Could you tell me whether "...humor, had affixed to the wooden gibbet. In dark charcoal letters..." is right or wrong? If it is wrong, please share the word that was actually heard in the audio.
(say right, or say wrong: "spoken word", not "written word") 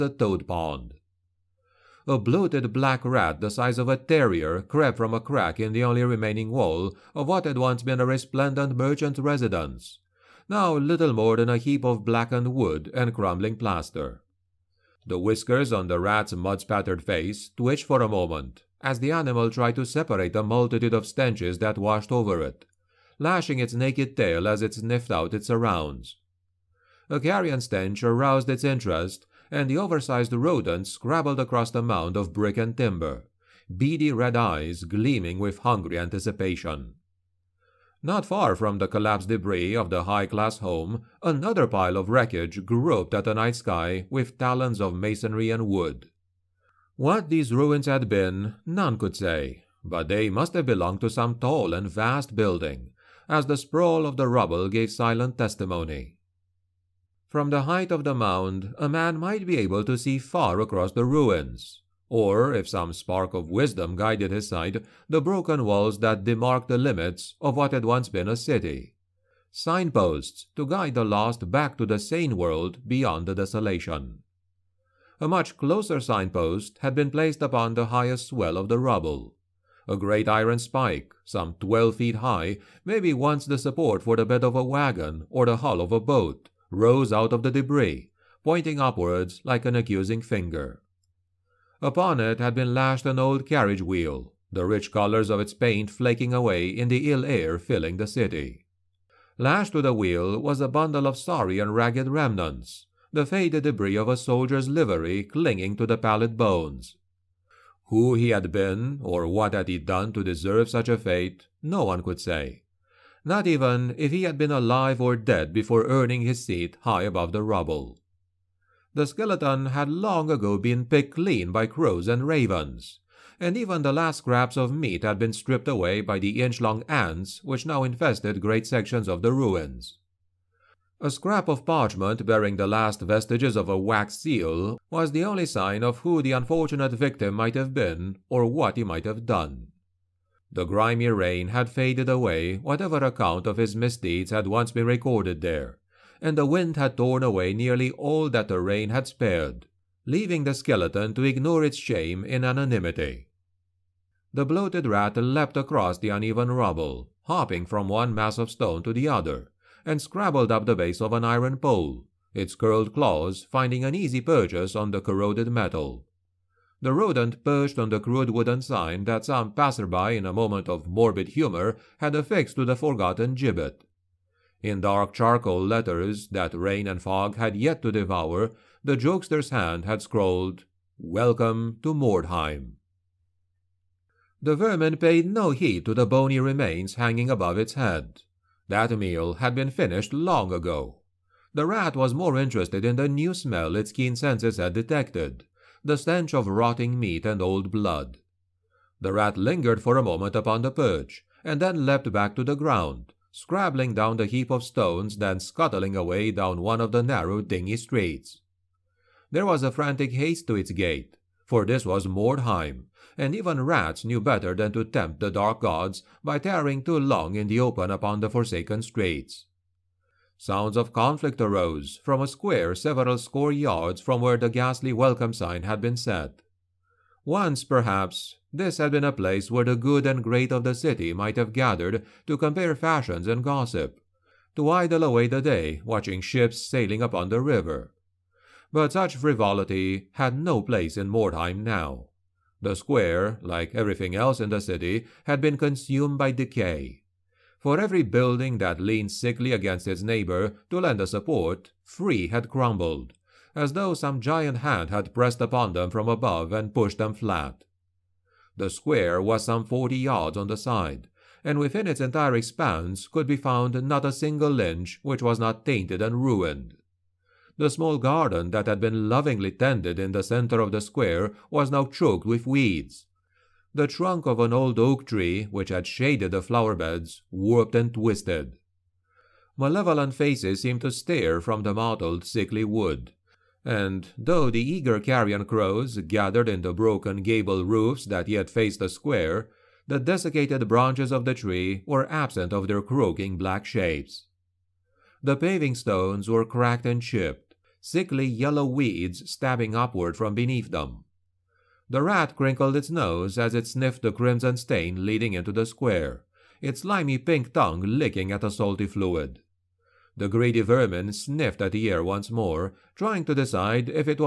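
wrong: "forgotten", not "wooden".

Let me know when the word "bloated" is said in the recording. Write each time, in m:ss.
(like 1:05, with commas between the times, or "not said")
0:02, 2:34.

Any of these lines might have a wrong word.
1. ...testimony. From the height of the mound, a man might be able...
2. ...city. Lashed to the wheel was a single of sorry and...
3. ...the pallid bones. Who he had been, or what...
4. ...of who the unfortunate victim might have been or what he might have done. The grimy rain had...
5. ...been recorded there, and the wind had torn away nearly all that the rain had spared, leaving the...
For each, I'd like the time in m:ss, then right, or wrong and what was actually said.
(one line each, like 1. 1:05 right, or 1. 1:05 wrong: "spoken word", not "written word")
1. 0:55 right
2. 1:38 wrong: "bundle", not "single"
3. 1:45 right
4. 2:15 right
5. 2:24 right.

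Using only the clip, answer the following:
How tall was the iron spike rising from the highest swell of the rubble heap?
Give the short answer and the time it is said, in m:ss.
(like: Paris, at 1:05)
12 feet, at 1:21.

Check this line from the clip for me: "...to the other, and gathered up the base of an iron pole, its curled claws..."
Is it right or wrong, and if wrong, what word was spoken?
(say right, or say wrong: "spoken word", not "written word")
wrong: "scrabbled", not "gathered".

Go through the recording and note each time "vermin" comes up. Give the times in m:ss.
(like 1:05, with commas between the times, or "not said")
3:04, 5:10.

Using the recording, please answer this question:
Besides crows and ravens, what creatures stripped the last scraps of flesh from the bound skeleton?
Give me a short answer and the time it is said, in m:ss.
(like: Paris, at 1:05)
inch-long ants, at 2:06.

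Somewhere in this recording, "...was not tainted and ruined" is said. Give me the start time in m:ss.
4:25.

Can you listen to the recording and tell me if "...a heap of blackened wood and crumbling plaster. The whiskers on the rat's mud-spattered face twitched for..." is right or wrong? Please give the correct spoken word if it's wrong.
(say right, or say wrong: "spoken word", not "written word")
right.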